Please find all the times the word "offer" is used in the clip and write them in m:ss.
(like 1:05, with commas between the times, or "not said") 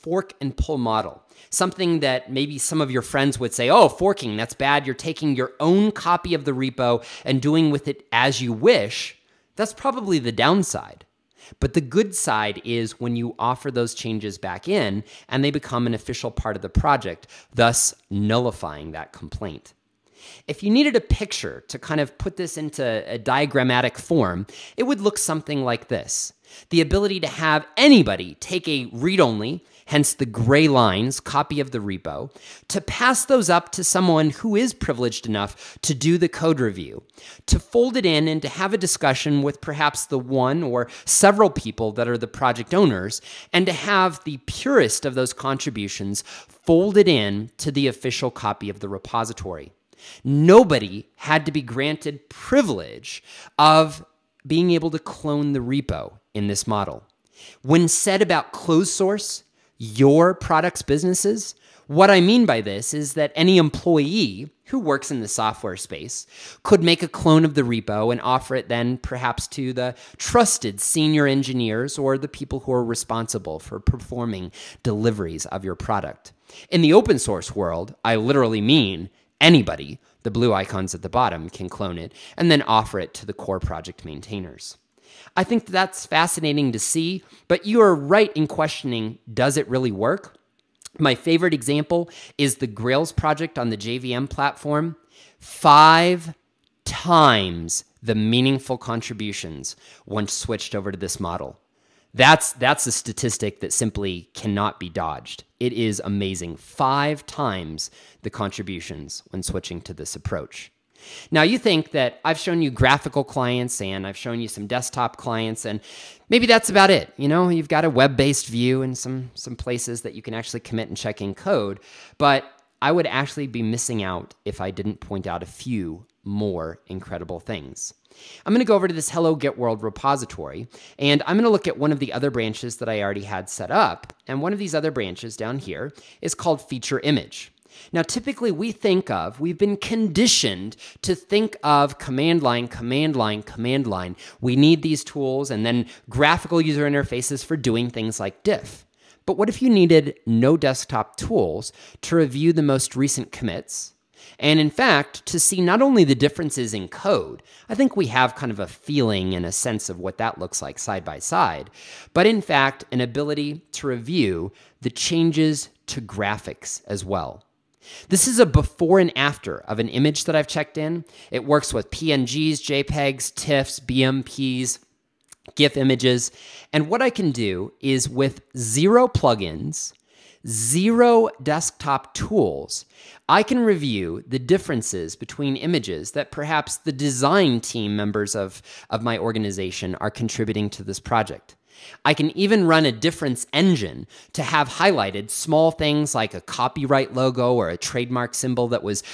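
0:13, 1:08, 1:22.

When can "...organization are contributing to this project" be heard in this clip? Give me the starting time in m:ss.
3:09.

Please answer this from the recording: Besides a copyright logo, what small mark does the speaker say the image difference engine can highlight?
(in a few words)
trademark symbol.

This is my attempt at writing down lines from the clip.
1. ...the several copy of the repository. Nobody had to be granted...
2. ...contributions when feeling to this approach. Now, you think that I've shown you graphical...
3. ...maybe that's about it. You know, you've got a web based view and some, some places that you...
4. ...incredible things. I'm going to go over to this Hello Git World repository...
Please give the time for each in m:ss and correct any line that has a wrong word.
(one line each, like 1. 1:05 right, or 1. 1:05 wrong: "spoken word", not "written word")
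1. 0:47 wrong: "official", not "several"
2. 1:48 wrong: "switching", not "feeling"
3. 1:56 right
4. 2:06 right.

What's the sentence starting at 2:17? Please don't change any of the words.
Now, typically we think of, we've been conditioned to think of command line, command line, command line.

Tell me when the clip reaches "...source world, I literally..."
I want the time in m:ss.
1:17.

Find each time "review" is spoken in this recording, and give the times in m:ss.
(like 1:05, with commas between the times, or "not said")
0:36, 2:32, 2:43, 3:03.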